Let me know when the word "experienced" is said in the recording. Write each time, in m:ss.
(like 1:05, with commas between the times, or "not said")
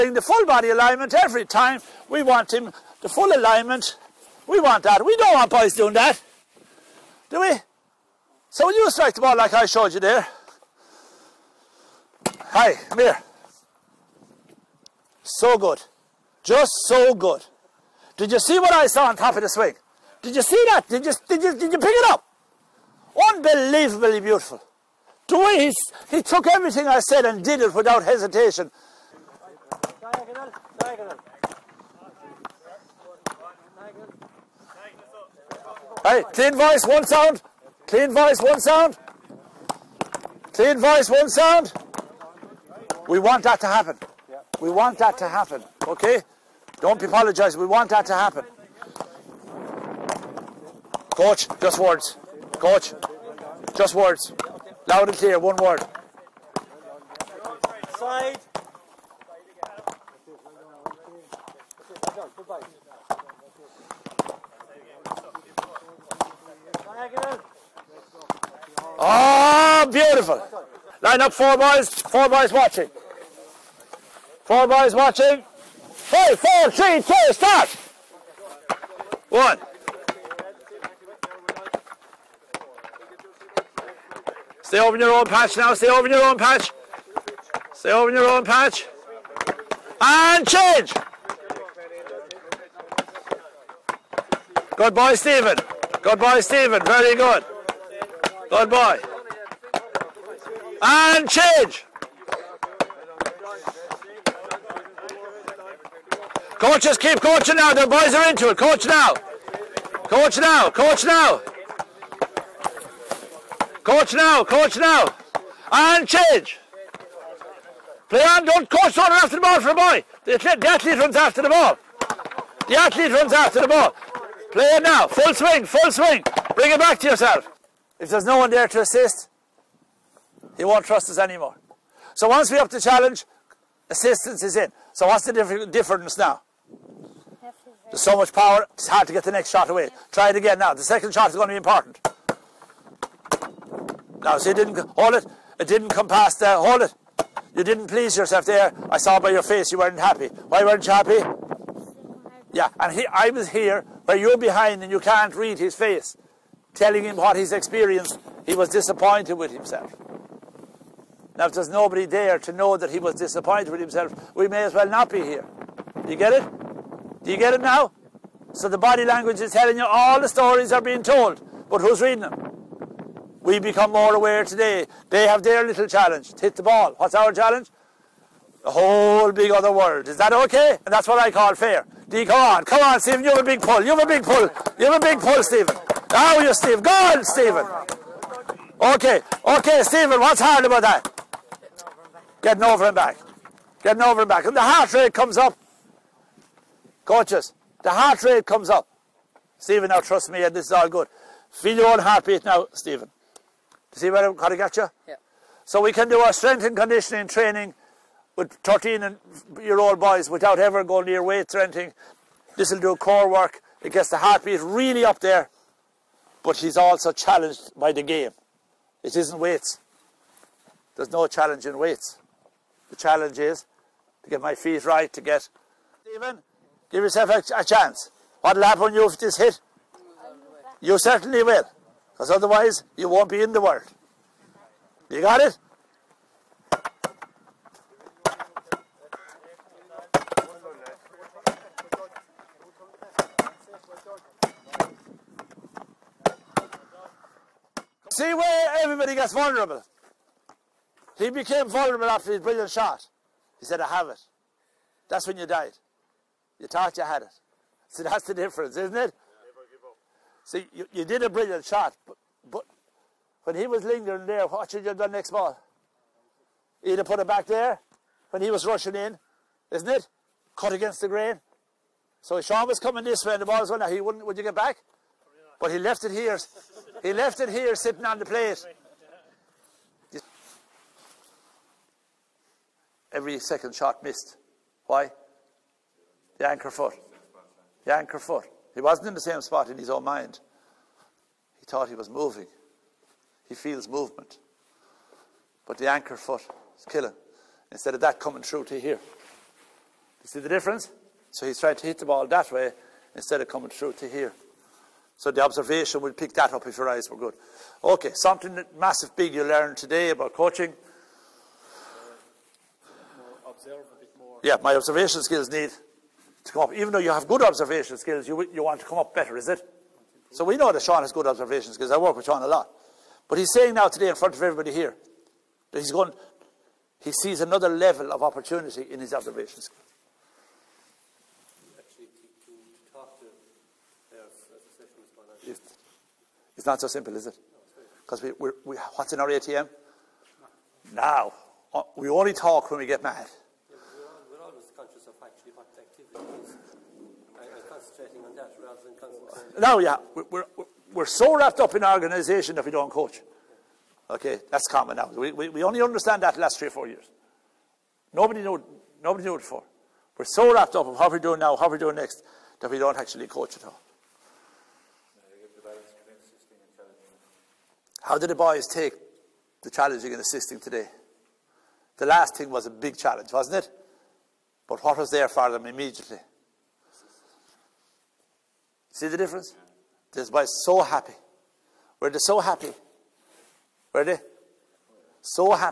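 2:37.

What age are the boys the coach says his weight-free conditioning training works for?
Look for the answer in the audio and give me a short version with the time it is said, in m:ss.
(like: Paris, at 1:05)
13, at 3:28.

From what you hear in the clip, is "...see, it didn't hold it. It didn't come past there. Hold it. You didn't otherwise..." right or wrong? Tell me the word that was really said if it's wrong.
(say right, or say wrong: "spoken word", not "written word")
wrong: "please", not "otherwise".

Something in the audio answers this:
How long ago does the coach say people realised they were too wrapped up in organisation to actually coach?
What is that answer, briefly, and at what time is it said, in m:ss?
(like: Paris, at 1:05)
3 or 4 years, at 5:56.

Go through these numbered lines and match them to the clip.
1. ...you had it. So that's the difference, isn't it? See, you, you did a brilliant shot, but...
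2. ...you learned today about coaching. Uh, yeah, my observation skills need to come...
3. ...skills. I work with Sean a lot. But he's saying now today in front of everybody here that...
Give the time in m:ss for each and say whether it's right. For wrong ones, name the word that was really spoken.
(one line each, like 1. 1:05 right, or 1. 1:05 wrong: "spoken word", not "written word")
1. 4:16 right
2. 5:09 right
3. 5:21 right.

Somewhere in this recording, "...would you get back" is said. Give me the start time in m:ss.
4:34.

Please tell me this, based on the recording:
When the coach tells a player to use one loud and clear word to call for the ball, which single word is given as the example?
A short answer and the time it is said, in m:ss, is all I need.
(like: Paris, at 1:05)
Side, at 0:57.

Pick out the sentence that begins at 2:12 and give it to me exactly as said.
So once we up the challenge, assistance is in.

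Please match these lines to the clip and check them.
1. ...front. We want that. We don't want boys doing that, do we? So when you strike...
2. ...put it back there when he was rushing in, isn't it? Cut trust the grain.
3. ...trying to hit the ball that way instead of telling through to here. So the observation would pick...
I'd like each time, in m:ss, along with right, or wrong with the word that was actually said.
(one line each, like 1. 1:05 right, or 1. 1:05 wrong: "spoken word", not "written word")
1. 0:03 wrong: "alignment", not "front"
2. 4:27 wrong: "against", not "trust"
3. 5:01 wrong: "coming", not "telling".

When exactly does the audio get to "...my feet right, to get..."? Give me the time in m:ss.
3:44.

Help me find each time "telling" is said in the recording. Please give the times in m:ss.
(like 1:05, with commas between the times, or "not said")
2:36, 2:49.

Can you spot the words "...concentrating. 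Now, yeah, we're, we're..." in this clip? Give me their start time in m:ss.
5:48.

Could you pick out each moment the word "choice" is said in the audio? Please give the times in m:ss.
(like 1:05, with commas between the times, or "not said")
not said.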